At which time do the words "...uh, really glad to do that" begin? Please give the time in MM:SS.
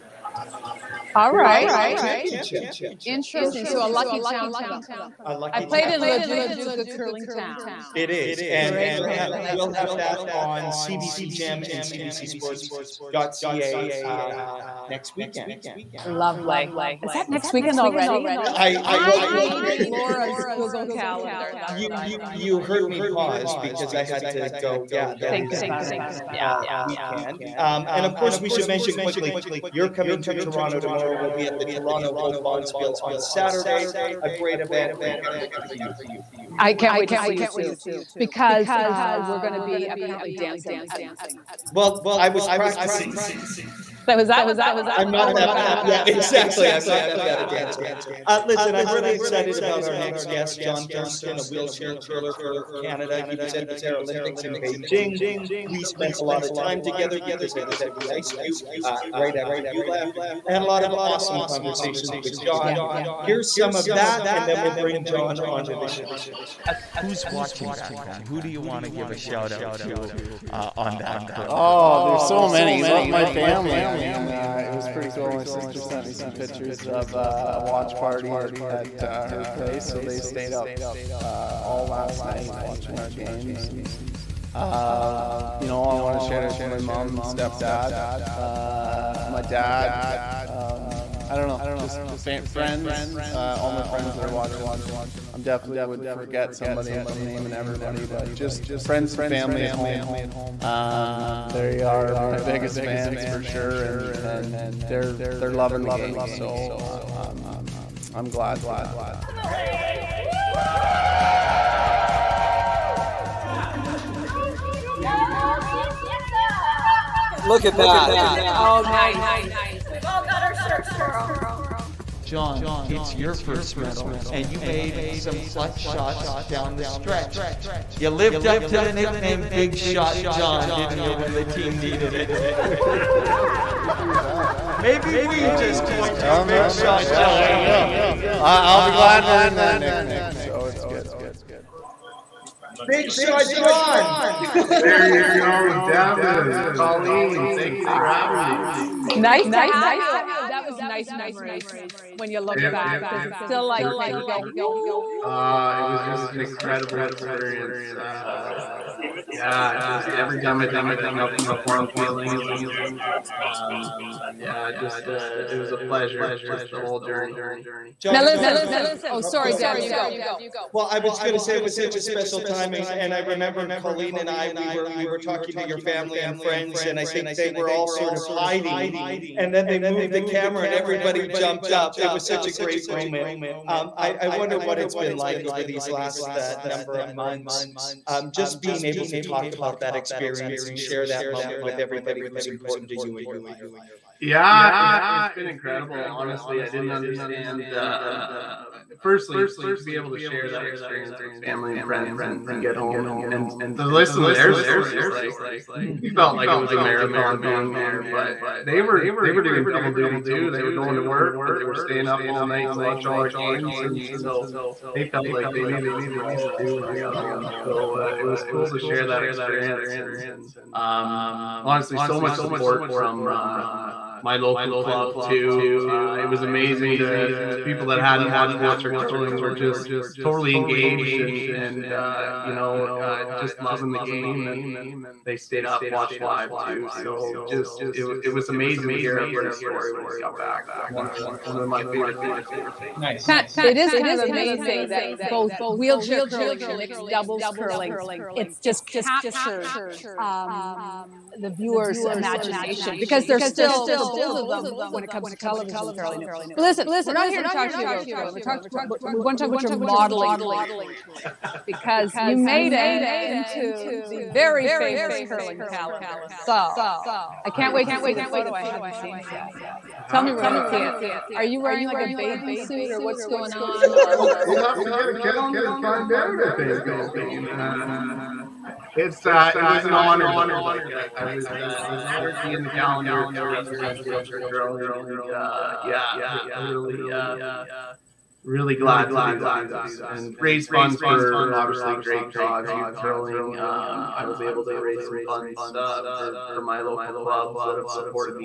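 04:47.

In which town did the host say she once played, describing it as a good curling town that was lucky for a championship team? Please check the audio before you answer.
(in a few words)
Leduc.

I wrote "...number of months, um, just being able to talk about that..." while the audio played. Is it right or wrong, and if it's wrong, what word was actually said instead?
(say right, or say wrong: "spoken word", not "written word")
right.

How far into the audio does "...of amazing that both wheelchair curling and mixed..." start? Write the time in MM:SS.
04:04.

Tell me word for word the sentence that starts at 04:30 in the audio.
Tell me we're going to see it.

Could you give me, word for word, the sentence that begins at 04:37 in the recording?
Uh, it's uh, it was an honor though.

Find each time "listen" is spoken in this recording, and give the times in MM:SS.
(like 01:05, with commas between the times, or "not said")
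00:48, 02:48, 03:23, 04:16.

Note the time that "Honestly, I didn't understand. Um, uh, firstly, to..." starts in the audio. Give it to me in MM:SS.
03:16.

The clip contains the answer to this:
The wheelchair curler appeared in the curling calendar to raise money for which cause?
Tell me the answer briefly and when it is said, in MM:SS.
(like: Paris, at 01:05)
youth curling, at 04:52.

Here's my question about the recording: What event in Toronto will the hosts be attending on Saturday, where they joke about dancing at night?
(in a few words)
Toronto Hope Bonspiel.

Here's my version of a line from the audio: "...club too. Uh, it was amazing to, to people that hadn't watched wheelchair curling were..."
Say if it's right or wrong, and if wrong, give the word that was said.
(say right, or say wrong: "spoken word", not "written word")
right.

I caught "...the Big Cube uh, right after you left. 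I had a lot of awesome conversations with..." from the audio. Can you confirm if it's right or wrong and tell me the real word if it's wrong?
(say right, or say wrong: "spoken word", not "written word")
wrong: "Ice", not "Big".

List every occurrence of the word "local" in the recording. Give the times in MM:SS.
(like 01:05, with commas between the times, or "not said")
03:44, 04:56.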